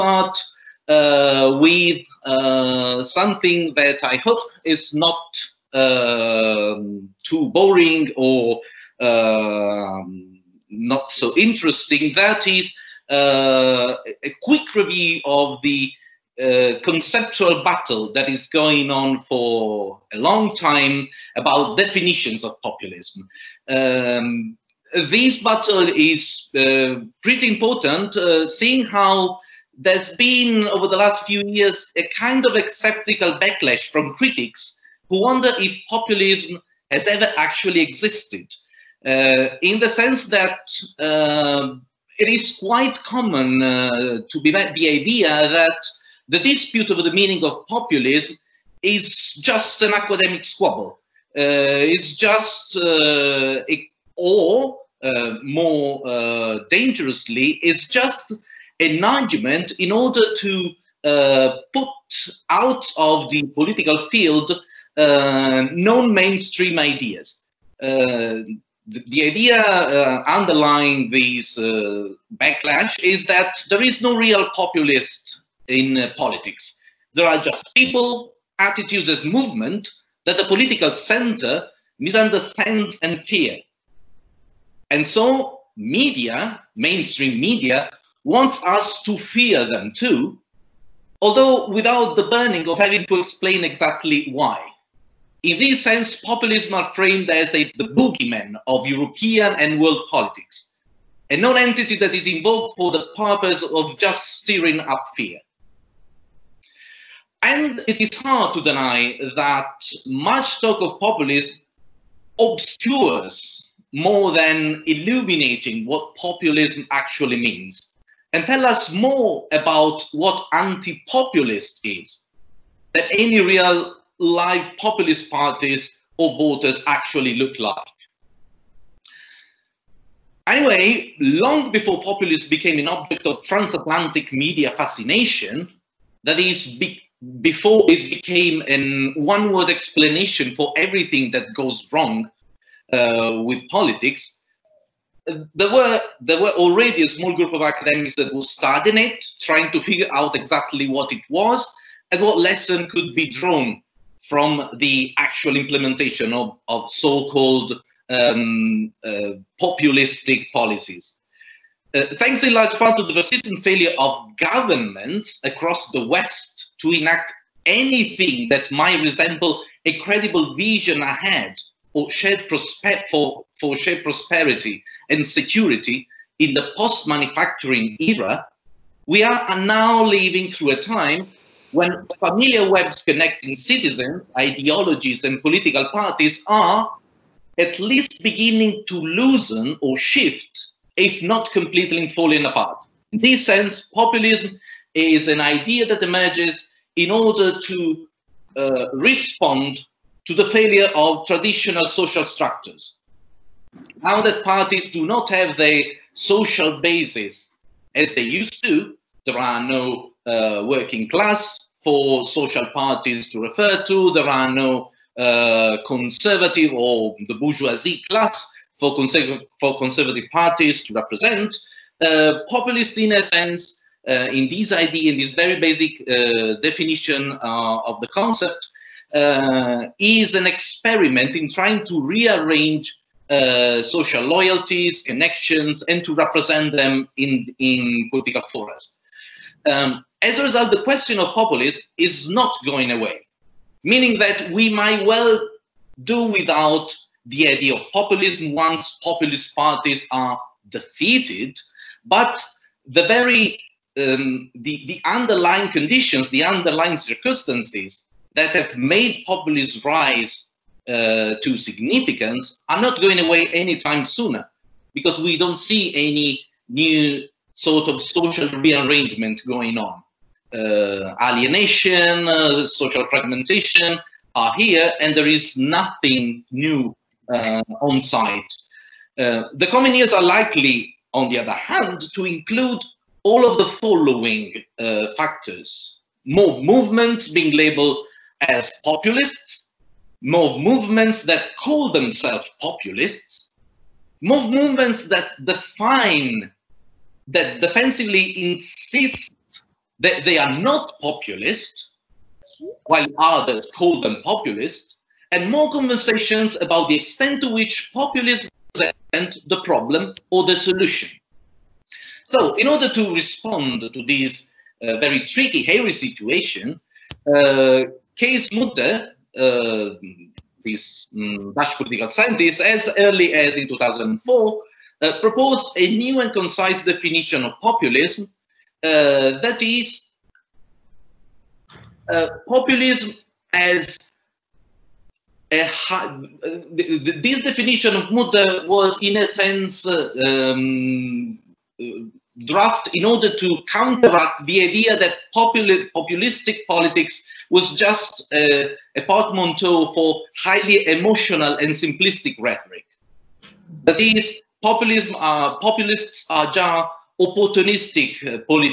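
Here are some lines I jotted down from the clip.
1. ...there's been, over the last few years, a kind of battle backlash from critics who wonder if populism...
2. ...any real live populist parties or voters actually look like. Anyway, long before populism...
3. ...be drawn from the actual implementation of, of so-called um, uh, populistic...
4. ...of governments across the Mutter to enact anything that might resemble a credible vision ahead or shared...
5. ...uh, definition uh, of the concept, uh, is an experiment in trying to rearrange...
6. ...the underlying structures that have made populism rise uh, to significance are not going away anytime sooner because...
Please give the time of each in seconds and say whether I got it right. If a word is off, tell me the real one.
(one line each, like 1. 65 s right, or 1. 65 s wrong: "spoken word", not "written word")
1. 29 s wrong: "acceptable", not "battle"
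2. 123 s right
3. 153 s right
4. 163 s wrong: "West", not "Mutter"
5. 226 s right
6. 256 s wrong: "circumstances", not "structures".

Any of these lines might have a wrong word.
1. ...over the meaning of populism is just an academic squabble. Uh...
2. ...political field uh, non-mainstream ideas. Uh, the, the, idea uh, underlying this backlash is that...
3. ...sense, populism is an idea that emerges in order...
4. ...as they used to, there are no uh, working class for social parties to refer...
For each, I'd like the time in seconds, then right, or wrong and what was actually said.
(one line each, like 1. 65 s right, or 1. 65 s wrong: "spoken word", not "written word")
1. 46 s right
2. 63 s right
3. 193 s right
4. 207 s right.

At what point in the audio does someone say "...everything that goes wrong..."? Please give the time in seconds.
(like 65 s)
140 s.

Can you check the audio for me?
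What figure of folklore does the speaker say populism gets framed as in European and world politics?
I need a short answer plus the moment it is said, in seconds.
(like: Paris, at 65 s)
the boogeyman, at 97 s.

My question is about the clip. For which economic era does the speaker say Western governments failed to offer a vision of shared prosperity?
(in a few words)
post manufacturing era.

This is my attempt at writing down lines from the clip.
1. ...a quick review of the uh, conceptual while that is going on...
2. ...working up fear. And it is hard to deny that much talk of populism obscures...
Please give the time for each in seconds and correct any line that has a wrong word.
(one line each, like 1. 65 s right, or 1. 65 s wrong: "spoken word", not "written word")
1. 14 s wrong: "battle", not "while"
2. 104 s wrong: "stirring", not "working".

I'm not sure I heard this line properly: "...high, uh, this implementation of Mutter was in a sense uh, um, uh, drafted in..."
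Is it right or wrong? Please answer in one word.
wrong.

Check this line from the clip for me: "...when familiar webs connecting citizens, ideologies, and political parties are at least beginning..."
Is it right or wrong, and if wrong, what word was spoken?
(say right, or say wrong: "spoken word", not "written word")
right.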